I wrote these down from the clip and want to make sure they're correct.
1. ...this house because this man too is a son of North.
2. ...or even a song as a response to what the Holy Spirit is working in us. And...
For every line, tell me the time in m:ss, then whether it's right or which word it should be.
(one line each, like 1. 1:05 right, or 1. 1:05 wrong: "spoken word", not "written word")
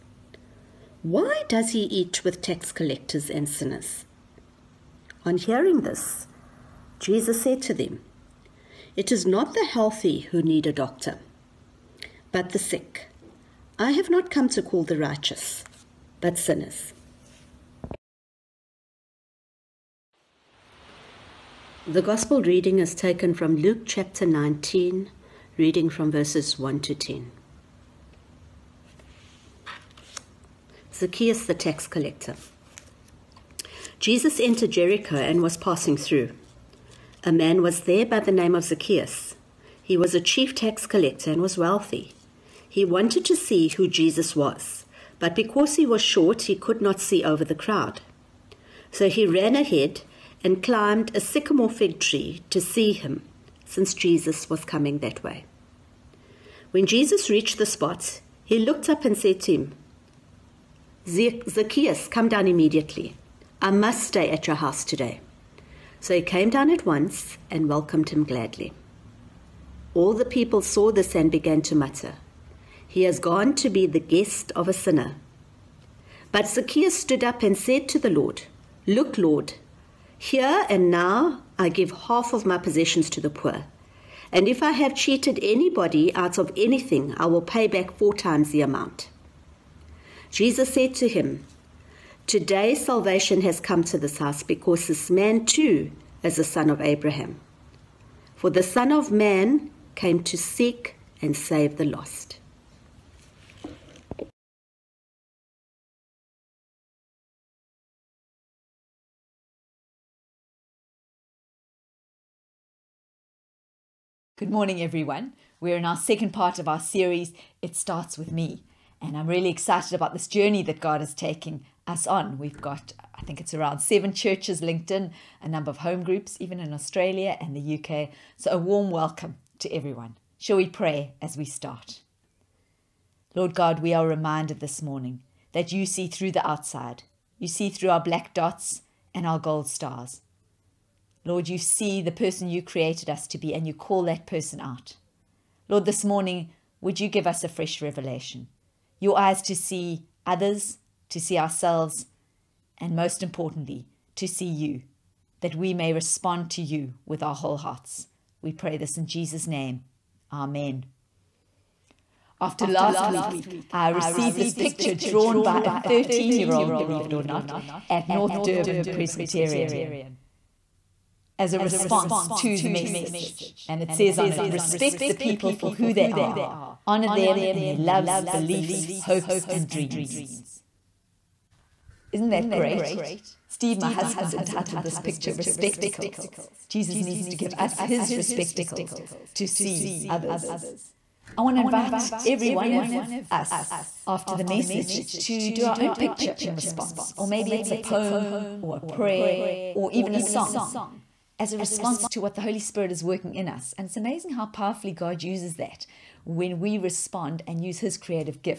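1. 1:33 wrong: "Abraham", not "North"
2. 3:19 right.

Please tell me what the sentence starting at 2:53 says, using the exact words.
And it says on it respect the people for who they are, honor them in their loves, beliefs, hopes, and dreams.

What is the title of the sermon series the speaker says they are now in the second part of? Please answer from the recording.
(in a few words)
It Starts With Me.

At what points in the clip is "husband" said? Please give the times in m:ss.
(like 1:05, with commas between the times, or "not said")
3:03.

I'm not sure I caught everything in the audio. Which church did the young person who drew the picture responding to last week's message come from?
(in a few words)
North Durban Presbyterian.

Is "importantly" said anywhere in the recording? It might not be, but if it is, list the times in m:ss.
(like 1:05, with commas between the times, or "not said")
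2:33.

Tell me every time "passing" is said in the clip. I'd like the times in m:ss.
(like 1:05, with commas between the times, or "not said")
0:35.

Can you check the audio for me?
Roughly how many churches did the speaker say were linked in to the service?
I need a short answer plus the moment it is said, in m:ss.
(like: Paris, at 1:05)
7, at 2:03.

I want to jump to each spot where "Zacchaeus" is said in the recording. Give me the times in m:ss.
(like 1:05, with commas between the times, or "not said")
0:30, 0:38, 1:01, 1:16.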